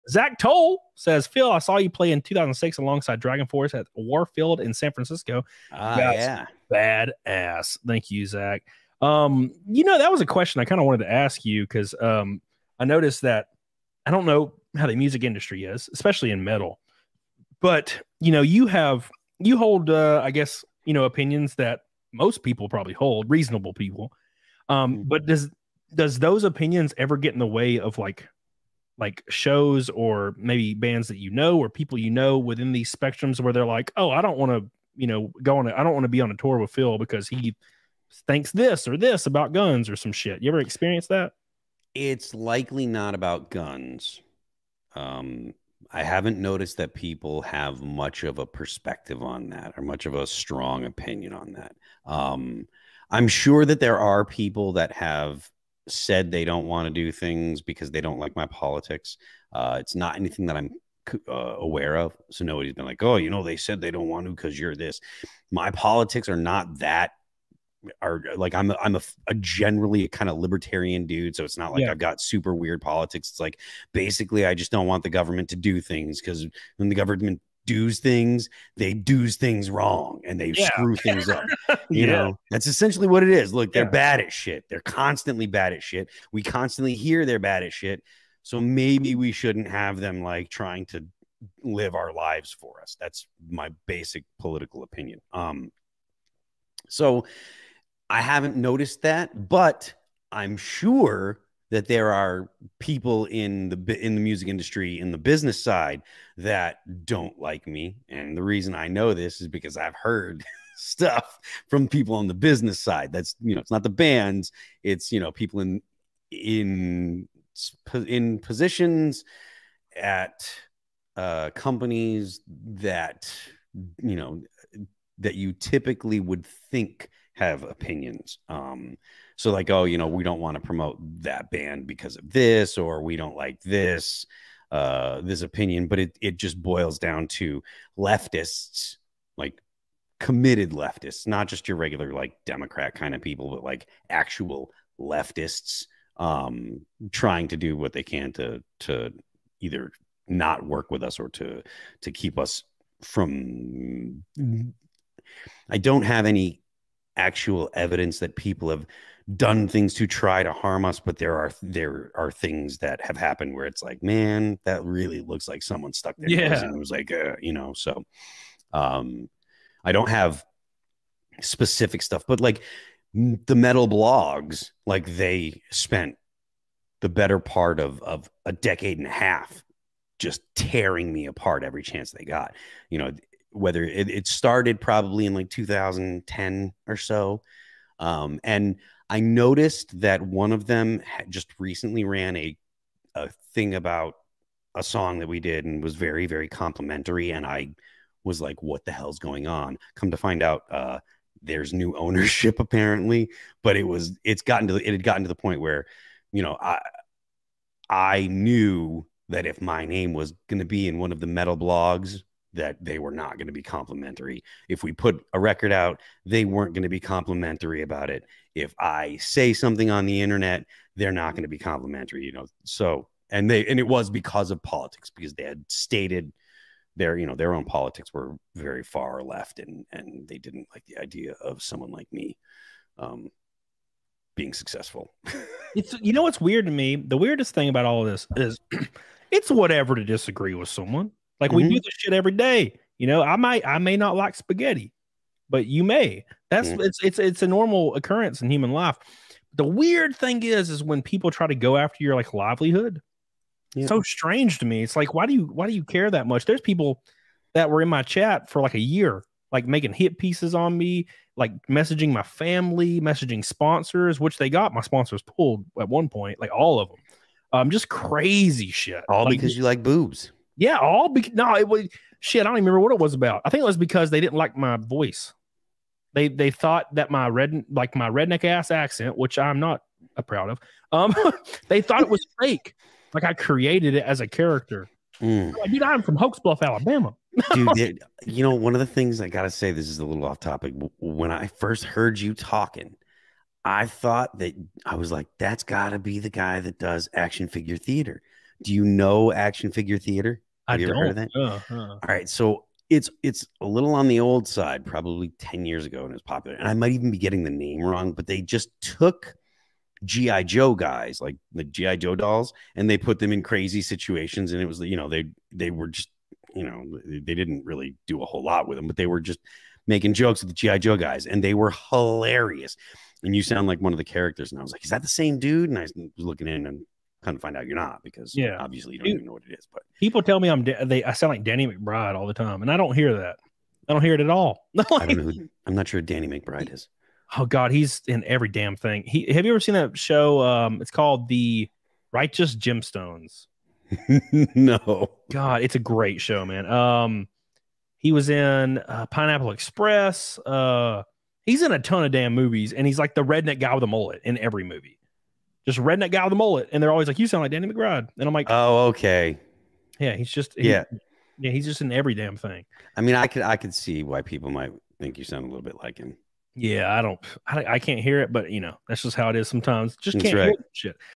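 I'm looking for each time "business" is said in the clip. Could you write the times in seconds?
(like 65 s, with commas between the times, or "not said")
105 s, 112 s.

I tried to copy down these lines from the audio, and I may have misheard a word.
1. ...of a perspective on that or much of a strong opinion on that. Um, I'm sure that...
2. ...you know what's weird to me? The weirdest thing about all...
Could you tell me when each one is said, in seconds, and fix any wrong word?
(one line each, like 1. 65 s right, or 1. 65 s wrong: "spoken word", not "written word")
1. 48 s right
2. 236 s right.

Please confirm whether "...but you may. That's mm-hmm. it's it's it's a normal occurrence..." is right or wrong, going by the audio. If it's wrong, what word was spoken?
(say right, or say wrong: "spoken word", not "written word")
right.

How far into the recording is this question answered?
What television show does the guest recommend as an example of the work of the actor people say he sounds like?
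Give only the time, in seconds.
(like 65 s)
341 s.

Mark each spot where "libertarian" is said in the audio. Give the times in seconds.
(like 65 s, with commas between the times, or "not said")
70 s.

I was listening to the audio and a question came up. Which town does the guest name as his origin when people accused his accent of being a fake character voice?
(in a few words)
Hokes Bluff, Alabama.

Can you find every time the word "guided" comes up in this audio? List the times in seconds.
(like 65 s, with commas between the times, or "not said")
not said.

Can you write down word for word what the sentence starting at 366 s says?
Yeah, I don't, I, I can't hear it, but you know, that's just how it is sometimes.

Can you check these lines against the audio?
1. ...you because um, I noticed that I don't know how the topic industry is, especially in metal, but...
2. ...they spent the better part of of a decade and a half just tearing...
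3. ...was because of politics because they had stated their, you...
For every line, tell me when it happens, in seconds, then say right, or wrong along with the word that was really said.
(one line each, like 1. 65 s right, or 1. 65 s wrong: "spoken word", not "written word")
1. 11 s wrong: "music", not "topic"
2. 175 s right
3. 223 s right.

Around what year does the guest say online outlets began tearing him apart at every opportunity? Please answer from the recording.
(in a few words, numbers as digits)
2010.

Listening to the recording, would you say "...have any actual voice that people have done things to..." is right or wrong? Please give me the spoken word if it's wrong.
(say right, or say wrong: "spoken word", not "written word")
wrong: "evidence", not "voice".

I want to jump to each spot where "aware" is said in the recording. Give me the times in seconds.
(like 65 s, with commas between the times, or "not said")
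61 s.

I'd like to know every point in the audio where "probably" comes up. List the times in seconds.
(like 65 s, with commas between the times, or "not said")
22 s, 184 s, 304 s.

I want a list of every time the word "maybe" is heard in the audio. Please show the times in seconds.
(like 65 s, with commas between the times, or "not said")
30 s, 88 s.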